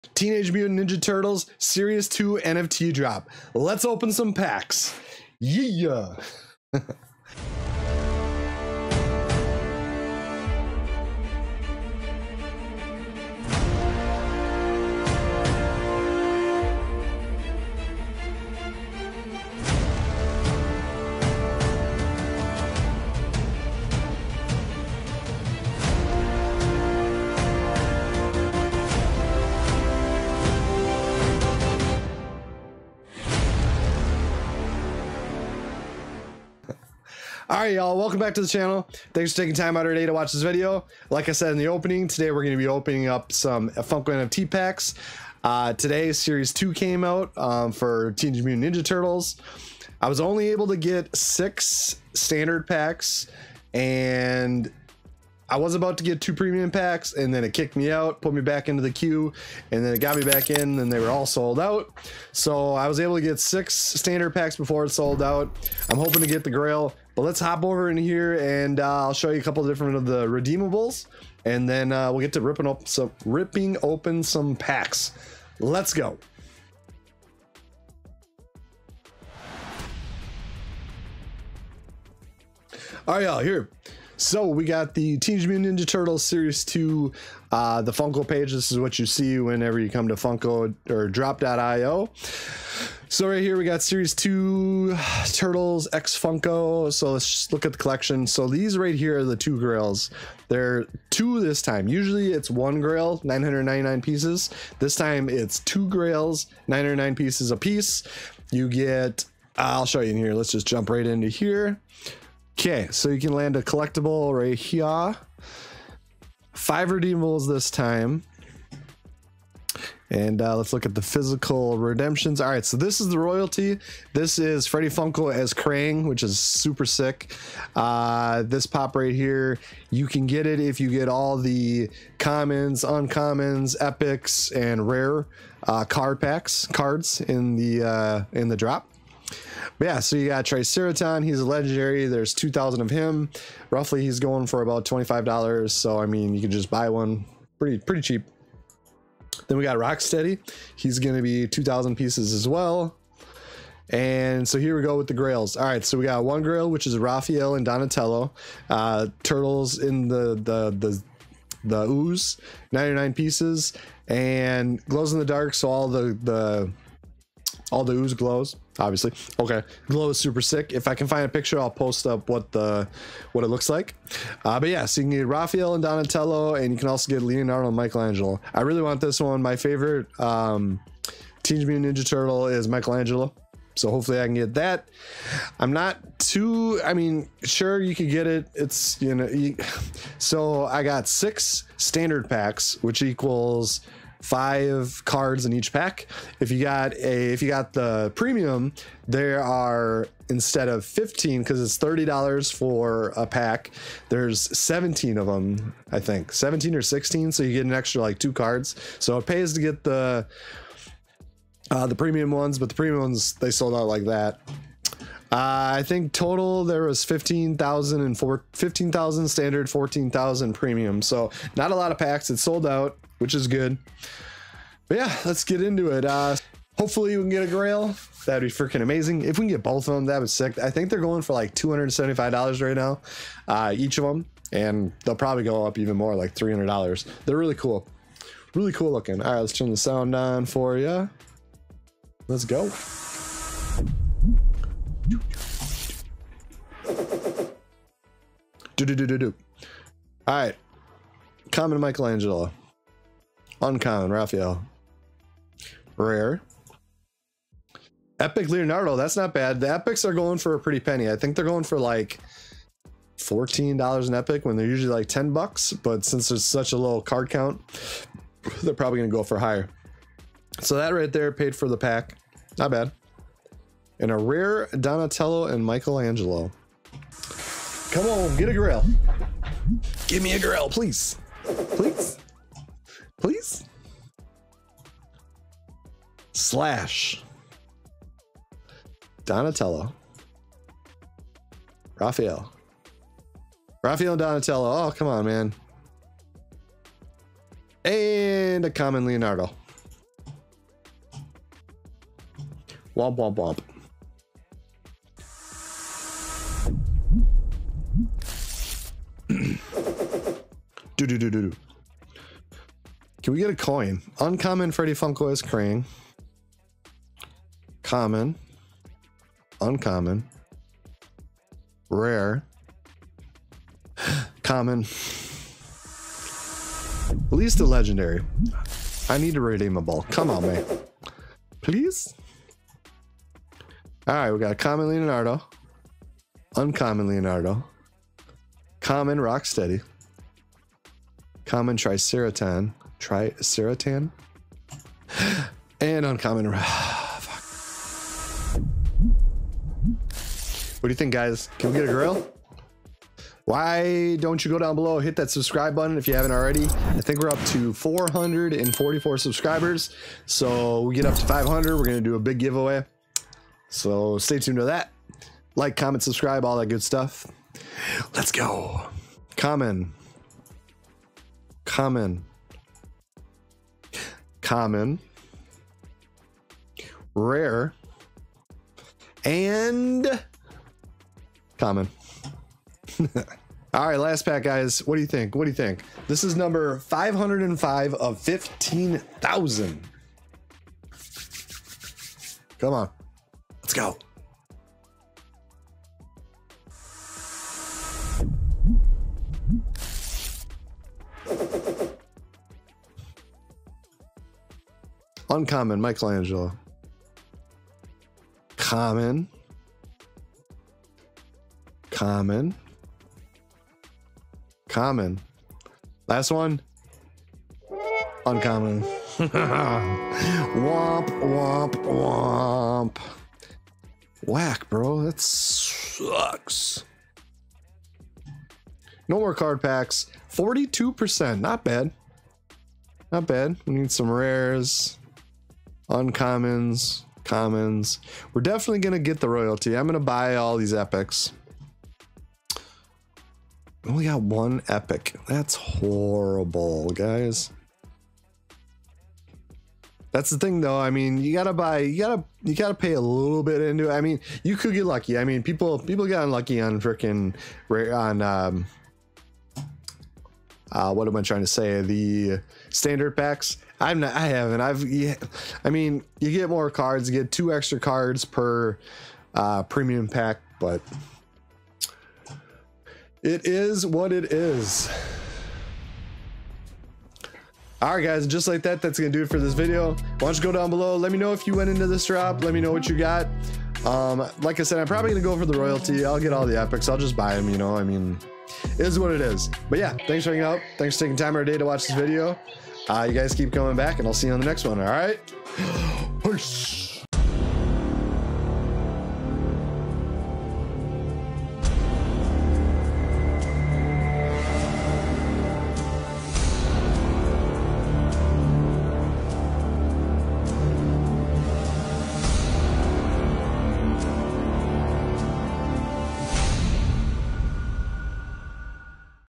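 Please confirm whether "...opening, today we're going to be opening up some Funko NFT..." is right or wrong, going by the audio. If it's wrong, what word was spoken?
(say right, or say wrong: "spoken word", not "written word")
right.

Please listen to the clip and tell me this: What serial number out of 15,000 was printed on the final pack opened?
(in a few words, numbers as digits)
505.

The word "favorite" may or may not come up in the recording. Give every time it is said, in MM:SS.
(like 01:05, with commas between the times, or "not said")
02:59.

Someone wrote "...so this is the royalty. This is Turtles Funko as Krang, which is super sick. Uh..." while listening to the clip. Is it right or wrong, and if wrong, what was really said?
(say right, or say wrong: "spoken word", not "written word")
wrong: "Freddy", not "Turtles".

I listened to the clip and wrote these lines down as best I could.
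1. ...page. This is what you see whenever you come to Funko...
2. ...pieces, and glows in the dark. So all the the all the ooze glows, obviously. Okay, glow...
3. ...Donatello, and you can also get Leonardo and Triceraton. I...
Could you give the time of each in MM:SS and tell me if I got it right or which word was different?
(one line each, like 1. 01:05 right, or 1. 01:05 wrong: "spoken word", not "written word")
1. 01:28 right
2. 02:43 right
3. 02:55 wrong: "Michelangelo", not "Triceraton".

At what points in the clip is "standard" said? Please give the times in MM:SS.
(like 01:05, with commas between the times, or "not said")
00:52, 01:03, 03:11, 03:39, 07:42.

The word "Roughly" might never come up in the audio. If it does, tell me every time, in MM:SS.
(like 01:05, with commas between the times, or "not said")
02:23.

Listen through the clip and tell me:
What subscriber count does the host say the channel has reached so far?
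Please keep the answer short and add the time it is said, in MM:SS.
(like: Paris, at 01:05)
444, at 05:57.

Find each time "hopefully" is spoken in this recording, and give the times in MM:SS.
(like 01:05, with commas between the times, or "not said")
03:03, 03:46.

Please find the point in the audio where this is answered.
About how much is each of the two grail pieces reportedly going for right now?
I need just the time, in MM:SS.
03:51.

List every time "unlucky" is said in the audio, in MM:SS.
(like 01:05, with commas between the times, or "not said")
07:36.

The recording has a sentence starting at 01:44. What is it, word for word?
This time it's two grails, 909 pieces a piece.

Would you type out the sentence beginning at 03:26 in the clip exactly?
17 or 16, so you get an extra like two cards.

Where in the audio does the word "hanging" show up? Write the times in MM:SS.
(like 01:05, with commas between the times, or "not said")
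08:10.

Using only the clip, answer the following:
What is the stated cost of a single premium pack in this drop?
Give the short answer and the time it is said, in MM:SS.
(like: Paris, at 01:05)
$30, at 03:21.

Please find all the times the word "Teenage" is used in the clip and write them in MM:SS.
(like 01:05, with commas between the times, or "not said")
00:00, 00:48, 01:25, 03:01.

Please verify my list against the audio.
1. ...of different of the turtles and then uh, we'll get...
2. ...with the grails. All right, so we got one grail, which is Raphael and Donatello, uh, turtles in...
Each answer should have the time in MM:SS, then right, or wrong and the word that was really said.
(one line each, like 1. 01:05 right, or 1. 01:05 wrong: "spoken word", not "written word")
1. 01:09 wrong: "redeemables", not "turtles"
2. 02:34 right.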